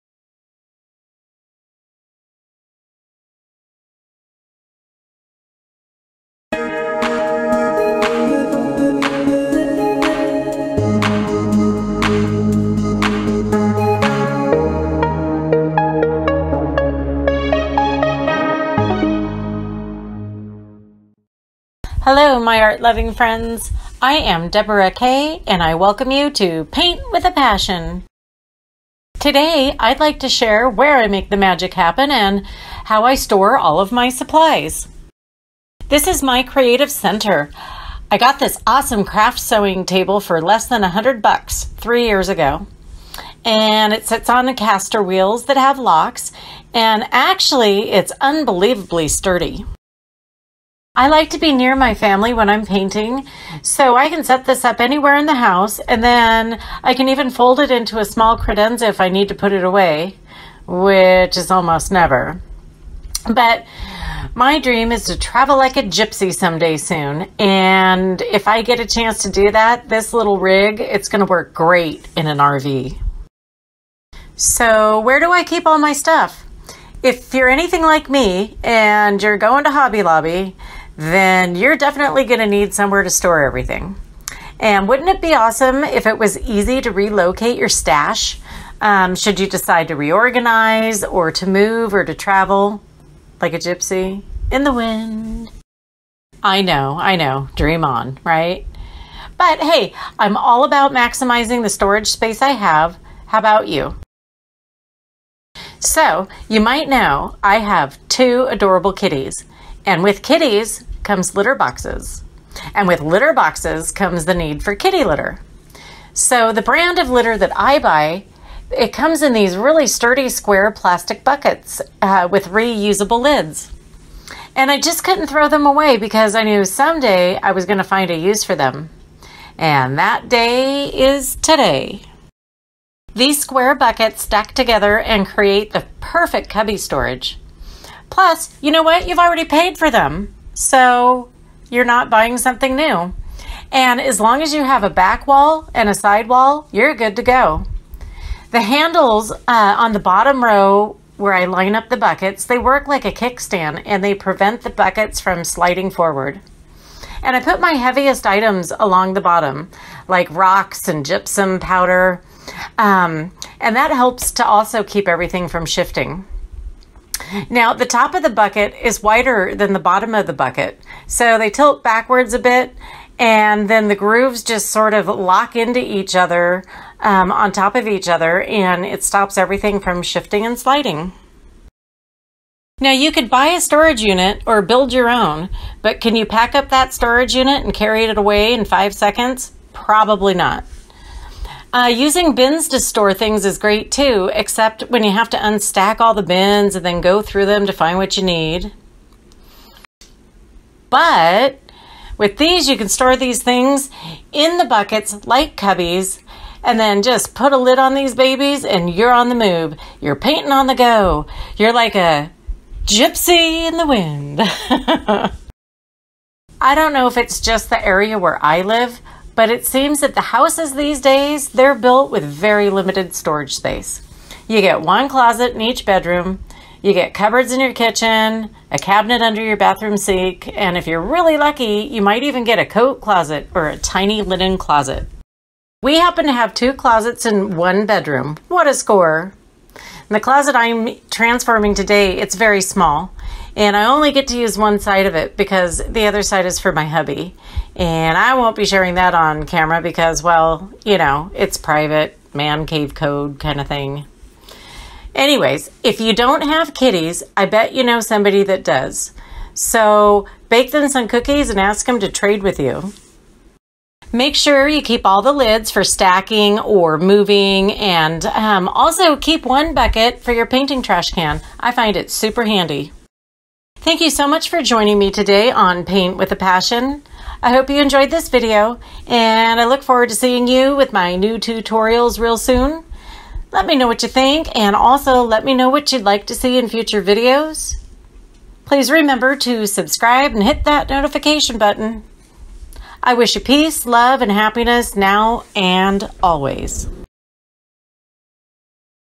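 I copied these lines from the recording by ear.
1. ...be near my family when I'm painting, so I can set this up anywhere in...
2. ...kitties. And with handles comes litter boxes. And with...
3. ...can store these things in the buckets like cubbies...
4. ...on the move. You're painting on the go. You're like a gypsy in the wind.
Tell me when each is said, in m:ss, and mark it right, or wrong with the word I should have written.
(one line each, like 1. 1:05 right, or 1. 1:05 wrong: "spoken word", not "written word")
1. 0:51 right
2. 1:48 wrong: "kitties", not "handles"
3. 3:22 right
4. 3:29 right.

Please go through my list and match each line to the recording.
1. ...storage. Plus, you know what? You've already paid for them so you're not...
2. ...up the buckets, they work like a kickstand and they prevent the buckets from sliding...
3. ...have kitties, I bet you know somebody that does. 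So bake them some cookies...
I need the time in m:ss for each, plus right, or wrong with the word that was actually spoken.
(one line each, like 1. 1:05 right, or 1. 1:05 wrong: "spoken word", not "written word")
1. 2:16 right
2. 2:31 right
3. 4:16 right.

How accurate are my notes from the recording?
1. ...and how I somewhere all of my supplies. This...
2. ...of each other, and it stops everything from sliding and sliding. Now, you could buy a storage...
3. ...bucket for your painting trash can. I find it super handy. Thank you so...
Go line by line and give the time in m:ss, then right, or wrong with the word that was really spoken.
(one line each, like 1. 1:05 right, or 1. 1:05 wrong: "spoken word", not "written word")
1. 0:32 wrong: "store", not "somewhere"
2. 2:57 wrong: "shifting", not "sliding"
3. 4:29 right.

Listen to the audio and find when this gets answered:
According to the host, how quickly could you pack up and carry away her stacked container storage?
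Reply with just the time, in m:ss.
3:08.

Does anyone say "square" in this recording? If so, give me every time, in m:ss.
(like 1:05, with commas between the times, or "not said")
2:00, 2:13.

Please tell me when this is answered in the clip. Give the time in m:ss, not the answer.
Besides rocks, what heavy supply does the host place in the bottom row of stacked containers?
2:41.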